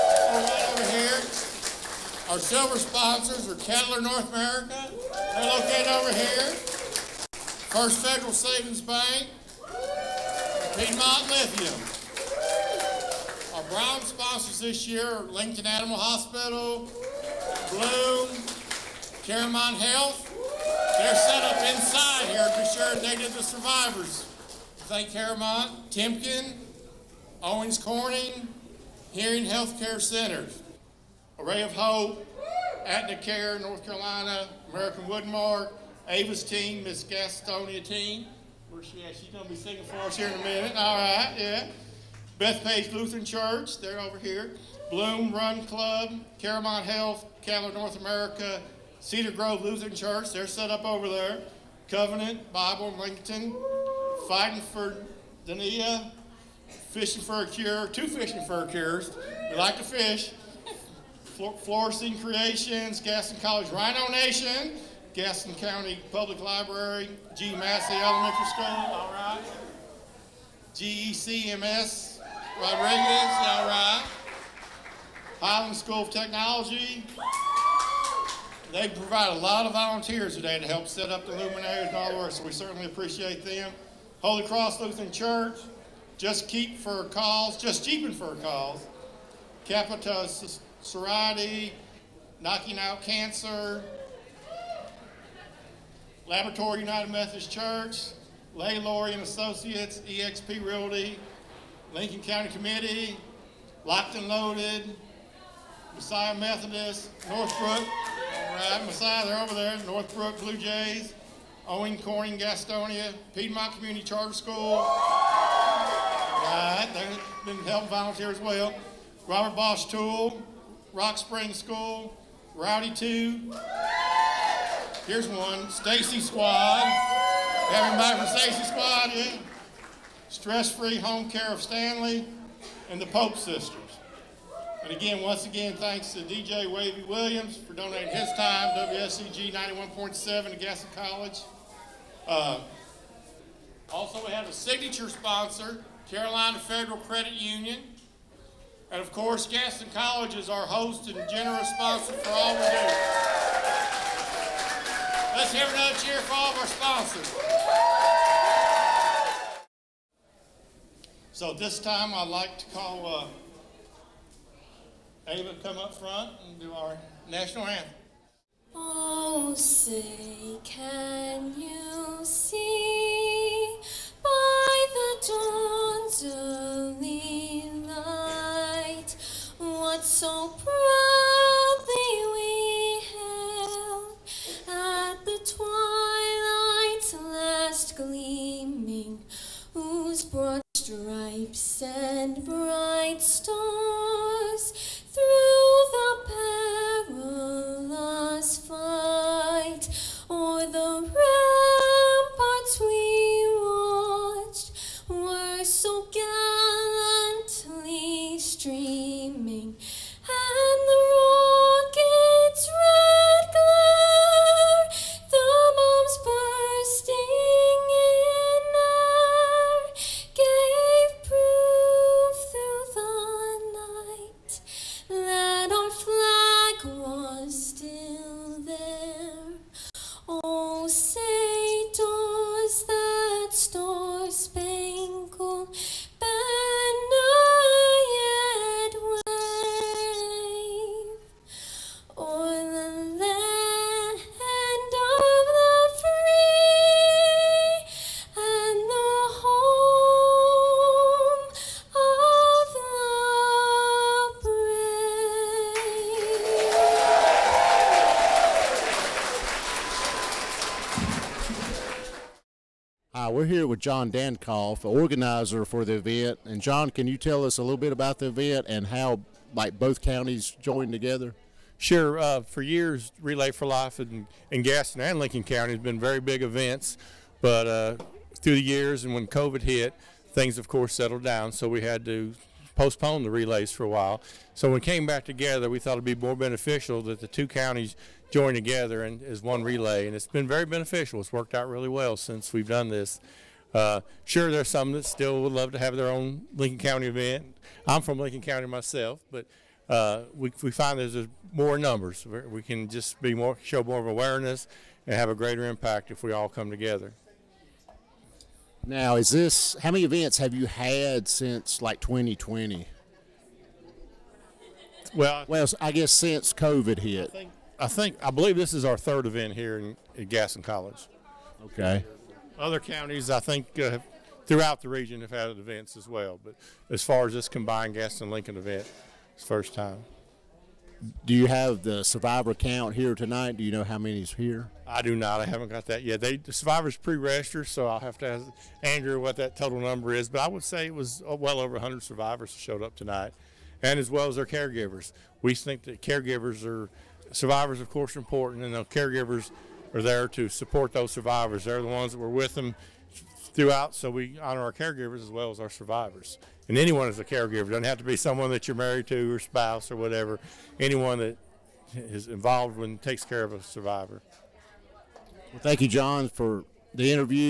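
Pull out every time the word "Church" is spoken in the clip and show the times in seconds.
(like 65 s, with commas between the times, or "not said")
43 s, 49 s, 85 s, 97 s.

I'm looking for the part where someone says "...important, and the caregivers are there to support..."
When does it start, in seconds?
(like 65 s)
348 s.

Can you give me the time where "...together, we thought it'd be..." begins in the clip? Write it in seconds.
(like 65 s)
285 s.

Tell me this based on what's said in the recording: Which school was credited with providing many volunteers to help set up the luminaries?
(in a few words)
Highland School of Technology.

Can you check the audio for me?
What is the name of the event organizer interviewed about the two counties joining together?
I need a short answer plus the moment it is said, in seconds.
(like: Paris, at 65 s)
John Dankoff, at 263 s.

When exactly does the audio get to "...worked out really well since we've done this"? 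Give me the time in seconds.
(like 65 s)
291 s.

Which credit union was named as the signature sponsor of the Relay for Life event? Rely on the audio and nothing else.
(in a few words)
Carolina Federal Credit Union.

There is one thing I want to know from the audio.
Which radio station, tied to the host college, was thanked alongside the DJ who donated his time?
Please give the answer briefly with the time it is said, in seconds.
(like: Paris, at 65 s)
WSGE 91.7, at 138 s.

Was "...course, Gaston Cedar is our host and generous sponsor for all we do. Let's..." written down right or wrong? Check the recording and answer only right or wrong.
wrong.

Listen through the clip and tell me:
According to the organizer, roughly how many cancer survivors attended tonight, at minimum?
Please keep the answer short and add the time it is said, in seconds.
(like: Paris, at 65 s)
over 100, at 341 s.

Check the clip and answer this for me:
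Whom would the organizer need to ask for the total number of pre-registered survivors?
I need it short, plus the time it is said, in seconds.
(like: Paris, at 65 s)
Andrew, at 338 s.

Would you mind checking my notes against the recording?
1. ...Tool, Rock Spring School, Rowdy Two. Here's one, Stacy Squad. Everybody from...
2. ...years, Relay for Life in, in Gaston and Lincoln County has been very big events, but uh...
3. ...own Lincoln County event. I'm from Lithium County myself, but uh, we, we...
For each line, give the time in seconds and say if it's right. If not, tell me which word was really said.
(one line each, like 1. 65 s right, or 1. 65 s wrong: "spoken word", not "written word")
1. 119 s right
2. 272 s right
3. 296 s wrong: "Lincoln", not "Lithium".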